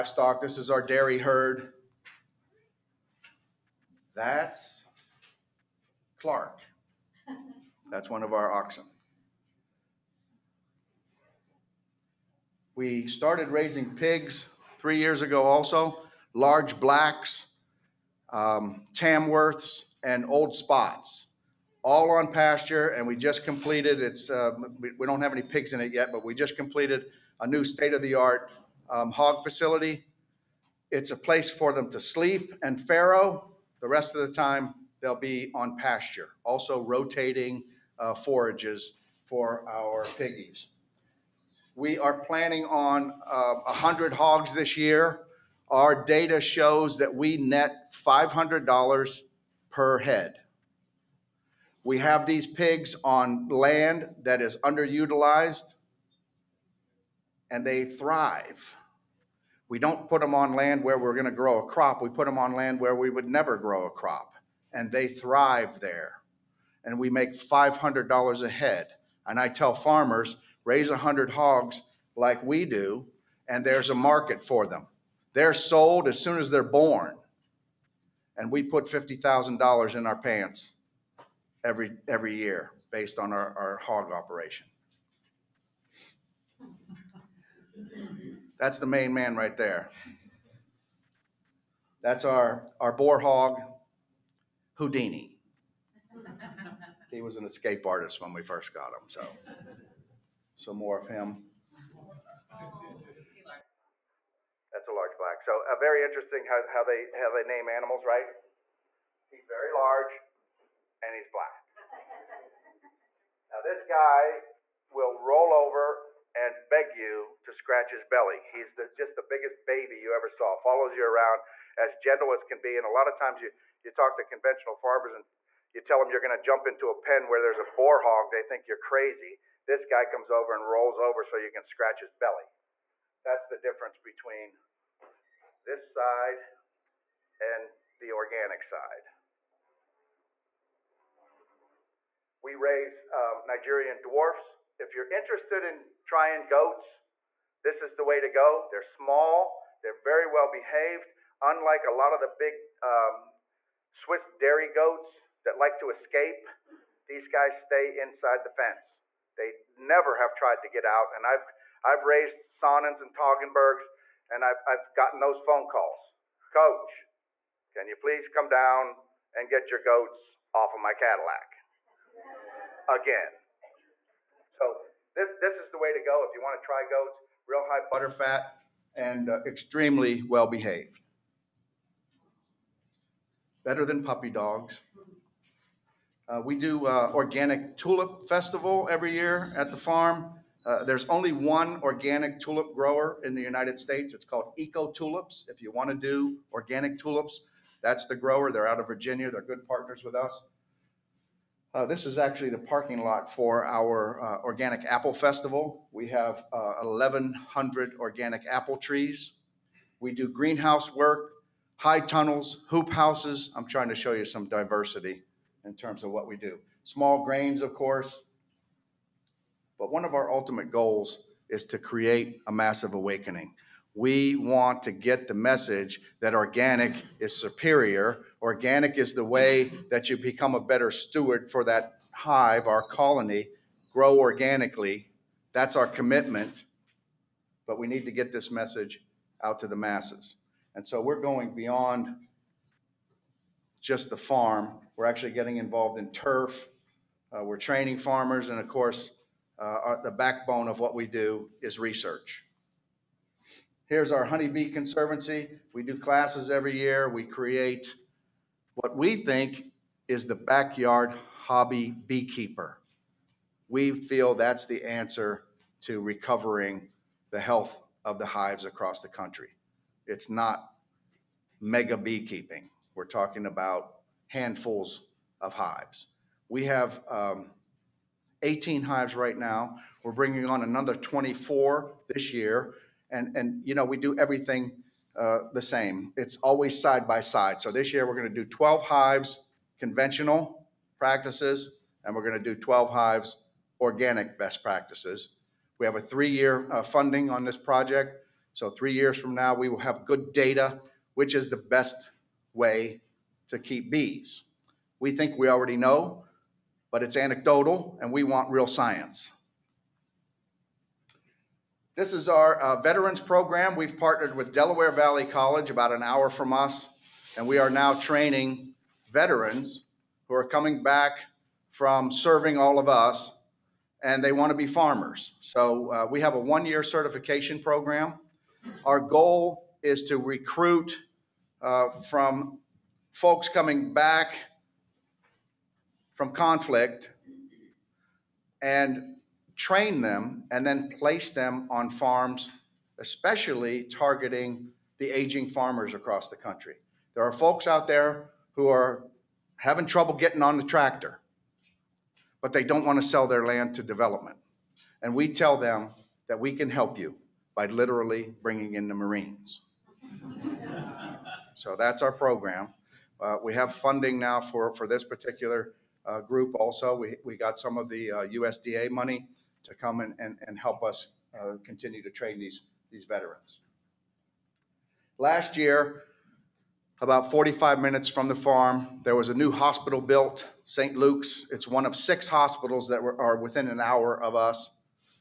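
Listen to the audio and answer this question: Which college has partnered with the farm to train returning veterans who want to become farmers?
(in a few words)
Delaware Valley College.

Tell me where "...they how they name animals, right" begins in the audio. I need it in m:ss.
1:46.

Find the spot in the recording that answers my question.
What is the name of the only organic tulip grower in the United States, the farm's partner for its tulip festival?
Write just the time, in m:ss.
3:14.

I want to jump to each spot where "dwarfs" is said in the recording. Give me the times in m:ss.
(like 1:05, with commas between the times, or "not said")
2:24.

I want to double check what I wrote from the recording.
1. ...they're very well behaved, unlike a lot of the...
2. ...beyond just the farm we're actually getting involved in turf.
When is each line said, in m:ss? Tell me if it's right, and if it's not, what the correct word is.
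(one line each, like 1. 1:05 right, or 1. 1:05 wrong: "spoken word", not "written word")
1. 2:29 right
2. 4:01 right.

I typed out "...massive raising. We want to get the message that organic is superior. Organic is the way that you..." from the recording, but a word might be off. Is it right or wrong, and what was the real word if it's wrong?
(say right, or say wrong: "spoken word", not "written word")
wrong: "awakening", not "raising".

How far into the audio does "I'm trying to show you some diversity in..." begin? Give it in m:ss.
3:33.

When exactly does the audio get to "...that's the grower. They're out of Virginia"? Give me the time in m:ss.
3:17.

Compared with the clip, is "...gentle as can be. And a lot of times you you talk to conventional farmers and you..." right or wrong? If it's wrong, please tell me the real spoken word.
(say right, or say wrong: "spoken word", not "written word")
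right.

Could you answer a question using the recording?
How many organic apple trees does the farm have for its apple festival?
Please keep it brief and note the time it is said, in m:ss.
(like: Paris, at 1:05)
1,100, at 3:26.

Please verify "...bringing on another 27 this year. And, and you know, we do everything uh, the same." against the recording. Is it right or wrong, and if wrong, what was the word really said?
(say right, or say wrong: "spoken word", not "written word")
wrong: "24", not "27".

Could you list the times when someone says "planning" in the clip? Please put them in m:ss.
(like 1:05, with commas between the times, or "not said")
0:42.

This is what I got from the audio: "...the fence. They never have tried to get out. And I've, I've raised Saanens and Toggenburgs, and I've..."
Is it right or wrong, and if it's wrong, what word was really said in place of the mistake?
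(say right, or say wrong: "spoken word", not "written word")
right.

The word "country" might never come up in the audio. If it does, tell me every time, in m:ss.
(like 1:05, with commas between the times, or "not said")
4:29, 5:46.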